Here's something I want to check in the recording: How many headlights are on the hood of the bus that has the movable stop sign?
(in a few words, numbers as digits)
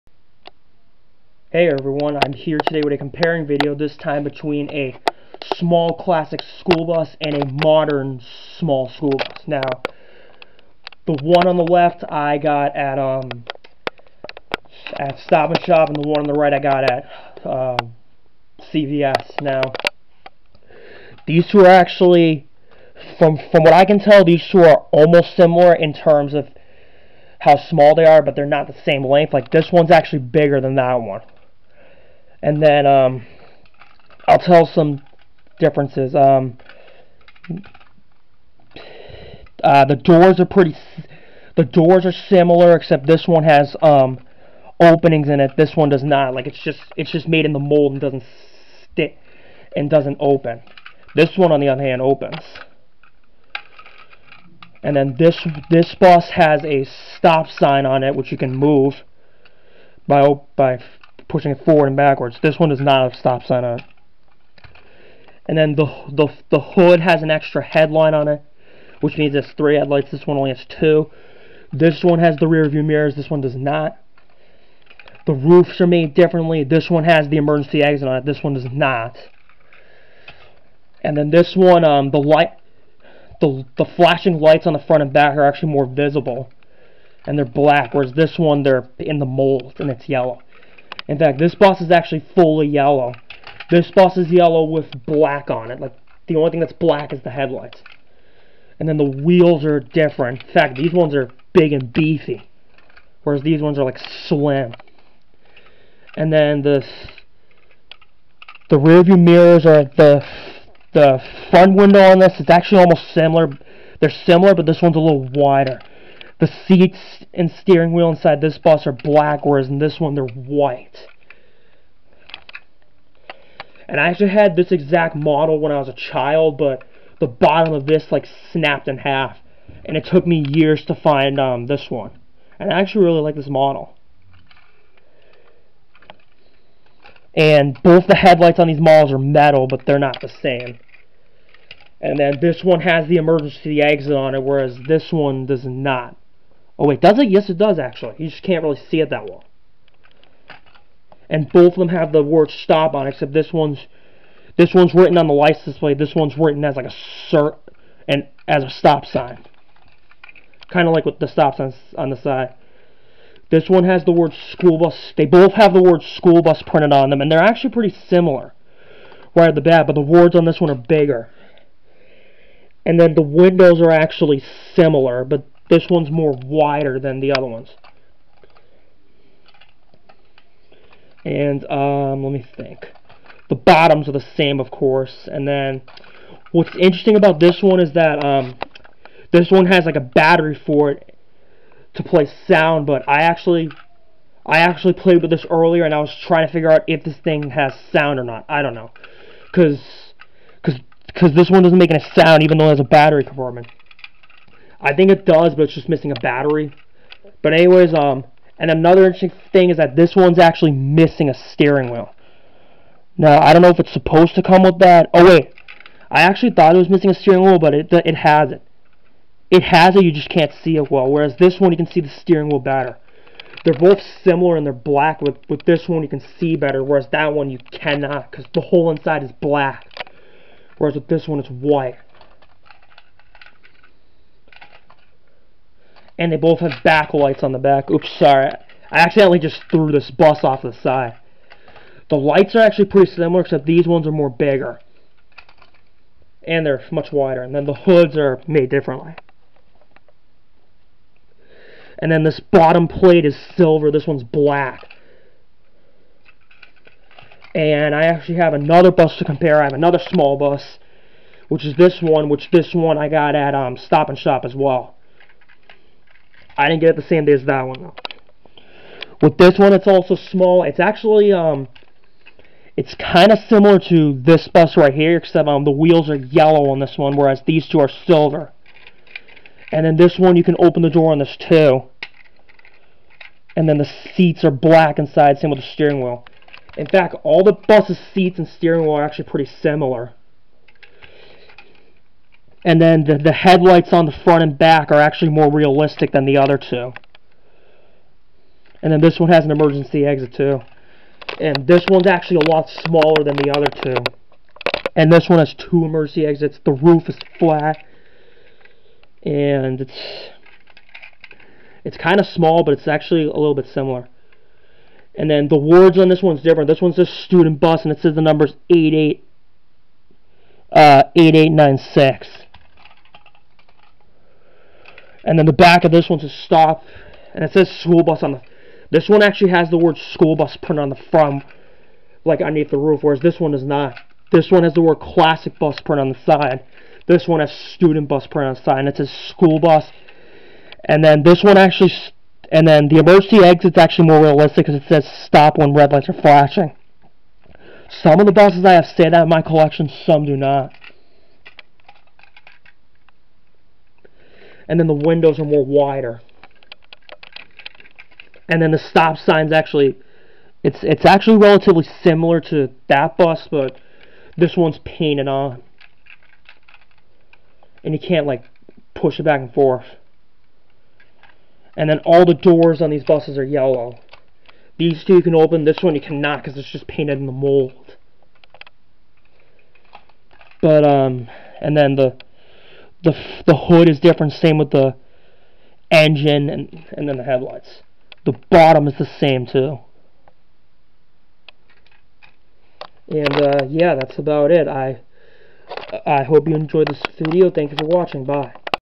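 3.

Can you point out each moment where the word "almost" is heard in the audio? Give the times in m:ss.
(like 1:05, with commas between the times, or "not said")
0:24, 1:52.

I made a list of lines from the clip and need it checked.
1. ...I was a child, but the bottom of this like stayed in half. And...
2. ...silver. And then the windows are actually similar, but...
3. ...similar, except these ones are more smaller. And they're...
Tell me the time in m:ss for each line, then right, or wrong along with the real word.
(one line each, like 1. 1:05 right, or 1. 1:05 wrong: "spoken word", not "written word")
1. 2:05 wrong: "snapped", not "stayed"
2. 2:50 wrong: "bigger", not "silver"
3. 4:03 wrong: "bigger", not "smaller".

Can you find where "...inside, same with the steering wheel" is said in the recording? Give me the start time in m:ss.
4:44.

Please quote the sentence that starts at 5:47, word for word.
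Some of the buses I have stayed at in my collection, some do not.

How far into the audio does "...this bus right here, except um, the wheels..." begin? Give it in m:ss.
4:34.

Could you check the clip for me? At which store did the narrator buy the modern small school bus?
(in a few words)
CVS.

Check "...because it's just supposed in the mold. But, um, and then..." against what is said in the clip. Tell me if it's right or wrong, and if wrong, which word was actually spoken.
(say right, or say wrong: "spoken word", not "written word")
wrong: "painted", not "supposed".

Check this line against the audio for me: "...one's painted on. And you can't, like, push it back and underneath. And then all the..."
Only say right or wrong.
wrong.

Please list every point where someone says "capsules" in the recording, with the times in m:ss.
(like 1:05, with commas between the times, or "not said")
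not said.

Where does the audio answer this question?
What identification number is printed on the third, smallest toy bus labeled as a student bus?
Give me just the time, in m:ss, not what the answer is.
5:21.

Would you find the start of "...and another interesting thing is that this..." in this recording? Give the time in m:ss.
3:28.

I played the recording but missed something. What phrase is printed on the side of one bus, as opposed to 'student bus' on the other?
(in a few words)
Classic bus.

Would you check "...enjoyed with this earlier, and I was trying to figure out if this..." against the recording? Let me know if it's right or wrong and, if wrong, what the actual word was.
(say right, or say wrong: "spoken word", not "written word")
wrong: "played", not "enjoyed".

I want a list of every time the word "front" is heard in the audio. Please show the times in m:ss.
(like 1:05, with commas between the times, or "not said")
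1:24, 1:51, 4:54, 5:31.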